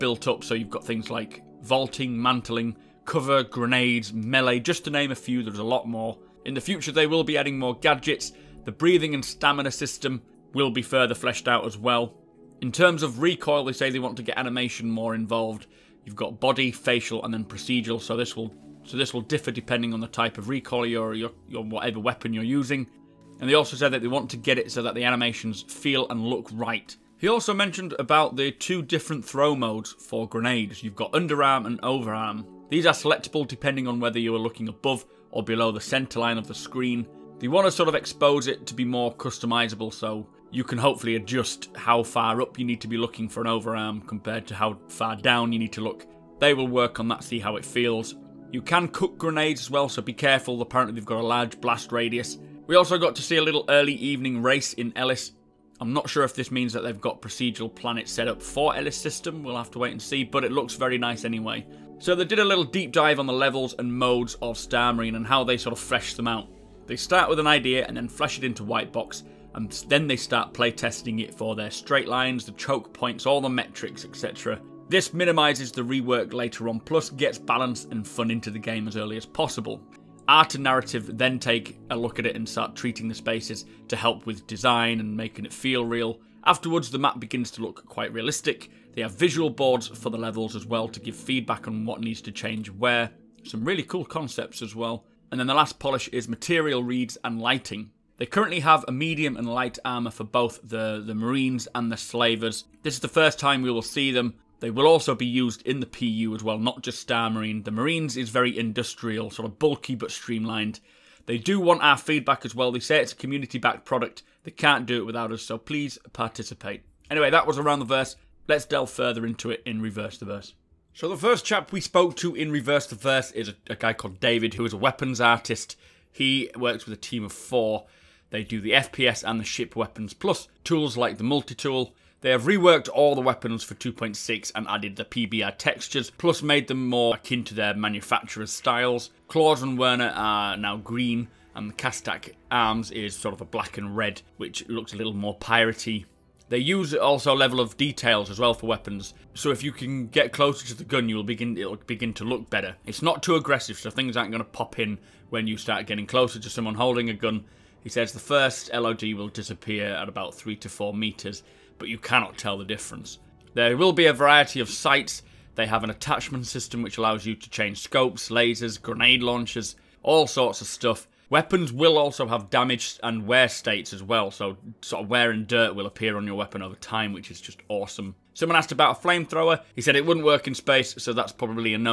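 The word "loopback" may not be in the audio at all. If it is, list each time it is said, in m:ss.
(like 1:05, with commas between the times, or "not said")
not said.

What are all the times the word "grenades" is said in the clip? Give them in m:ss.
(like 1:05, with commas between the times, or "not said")
0:03, 0:30, 0:49, 2:48.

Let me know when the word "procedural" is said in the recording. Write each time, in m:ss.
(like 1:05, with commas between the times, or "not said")
0:17, 0:57.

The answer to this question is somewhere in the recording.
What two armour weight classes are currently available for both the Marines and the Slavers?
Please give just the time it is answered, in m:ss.
1:38.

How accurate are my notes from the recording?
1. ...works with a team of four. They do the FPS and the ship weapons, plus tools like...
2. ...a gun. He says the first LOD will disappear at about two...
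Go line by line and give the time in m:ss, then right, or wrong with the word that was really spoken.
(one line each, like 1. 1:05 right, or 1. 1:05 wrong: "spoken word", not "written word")
1. 2:06 right
2. 2:37 wrong: "three", not "two".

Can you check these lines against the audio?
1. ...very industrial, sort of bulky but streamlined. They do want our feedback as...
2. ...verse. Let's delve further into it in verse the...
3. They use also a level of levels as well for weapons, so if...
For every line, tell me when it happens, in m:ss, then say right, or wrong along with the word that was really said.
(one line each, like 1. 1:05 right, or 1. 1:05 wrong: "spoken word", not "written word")
1. 1:48 right
2. 1:57 wrong: "reverse", not "verse"
3. 2:26 wrong: "details", not "levels".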